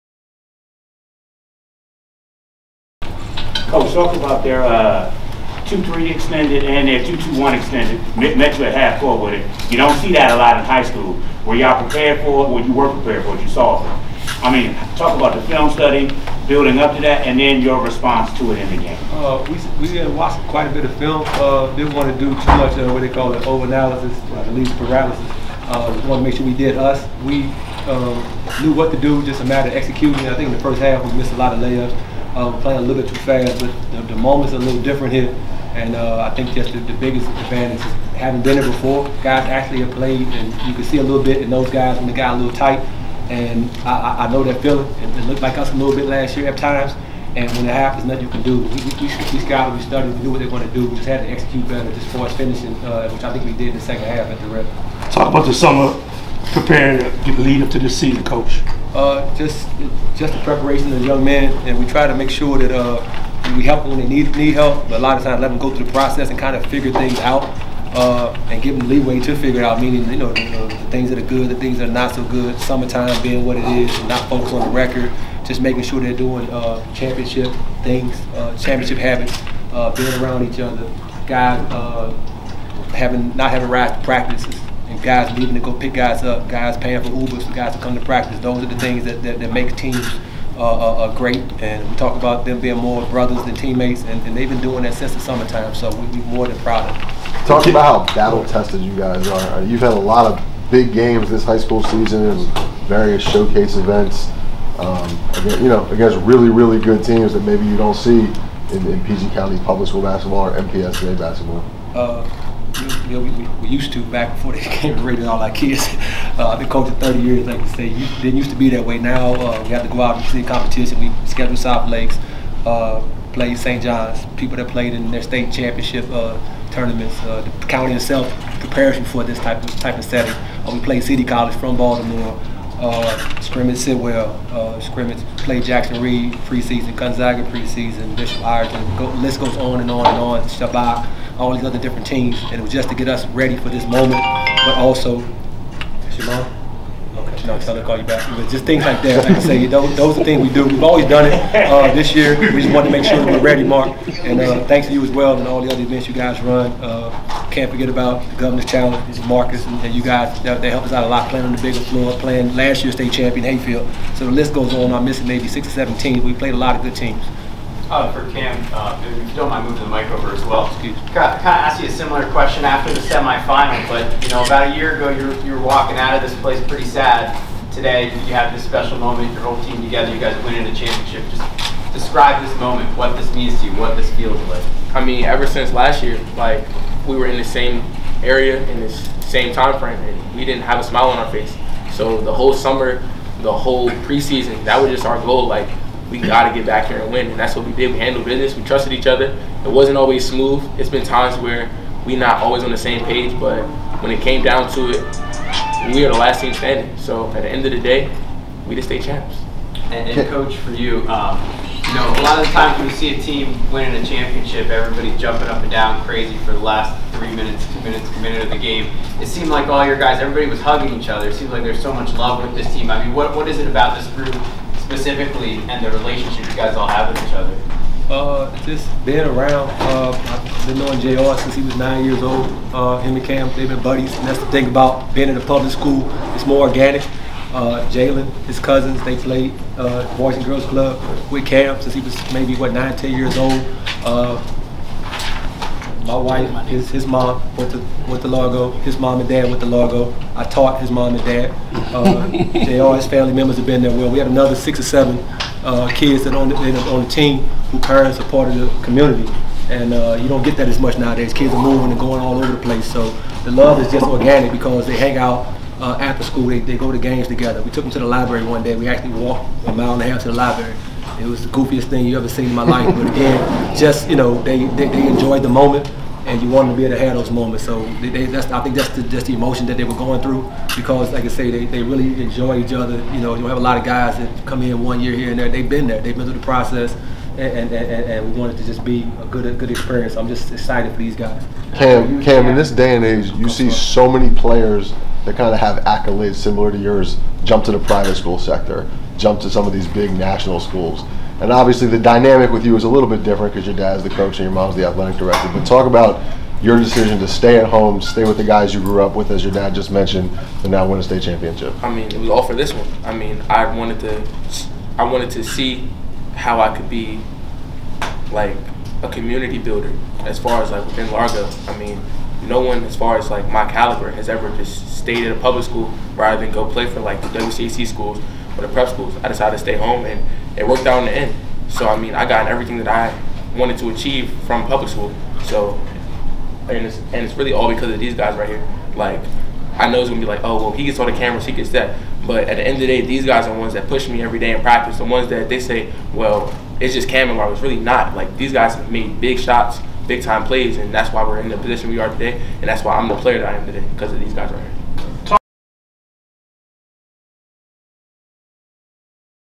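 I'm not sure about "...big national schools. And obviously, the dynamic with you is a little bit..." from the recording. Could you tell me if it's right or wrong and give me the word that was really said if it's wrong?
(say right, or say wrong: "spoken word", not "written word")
right.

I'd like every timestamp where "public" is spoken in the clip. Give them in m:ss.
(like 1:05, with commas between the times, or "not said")
1:49, 3:55, 5:25, 5:34.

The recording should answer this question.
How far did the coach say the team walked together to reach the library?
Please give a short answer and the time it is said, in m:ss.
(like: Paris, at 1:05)
a mile and a half, at 4:29.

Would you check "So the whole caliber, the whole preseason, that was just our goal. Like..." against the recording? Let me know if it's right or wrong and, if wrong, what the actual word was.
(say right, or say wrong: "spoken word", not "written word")
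wrong: "summer", not "caliber".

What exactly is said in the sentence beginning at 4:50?
I'm just excited for these guys.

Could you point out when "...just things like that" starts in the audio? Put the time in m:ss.
2:28.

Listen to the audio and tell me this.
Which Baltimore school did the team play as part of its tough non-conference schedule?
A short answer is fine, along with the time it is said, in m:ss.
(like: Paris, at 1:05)
City College, at 2:11.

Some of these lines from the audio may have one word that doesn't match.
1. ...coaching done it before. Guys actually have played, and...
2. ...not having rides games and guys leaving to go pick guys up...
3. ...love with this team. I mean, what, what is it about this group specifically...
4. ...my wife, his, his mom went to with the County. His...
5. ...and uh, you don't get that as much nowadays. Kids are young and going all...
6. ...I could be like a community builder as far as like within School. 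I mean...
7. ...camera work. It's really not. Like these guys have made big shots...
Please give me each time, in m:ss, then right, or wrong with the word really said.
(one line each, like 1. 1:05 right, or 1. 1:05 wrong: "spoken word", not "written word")
1. 0:38 wrong: "having", not "coaching"
2. 1:23 wrong: "practices", not "games"
3. 3:42 right
4. 4:06 wrong: "Largo", not "County"
5. 4:19 wrong: "moving", not "young"
6. 5:16 wrong: "Largo", not "School"
7. 5:47 right.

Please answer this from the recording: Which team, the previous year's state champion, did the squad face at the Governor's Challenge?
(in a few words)
Hayfield.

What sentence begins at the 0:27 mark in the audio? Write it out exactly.
We um, knew what to do, just a matter of executing.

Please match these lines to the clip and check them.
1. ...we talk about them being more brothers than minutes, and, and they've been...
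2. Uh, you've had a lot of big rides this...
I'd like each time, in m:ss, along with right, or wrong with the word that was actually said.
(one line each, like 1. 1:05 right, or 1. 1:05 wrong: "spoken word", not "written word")
1. 1:31 wrong: "teammates", not "minutes"
2. 1:39 wrong: "games", not "rides".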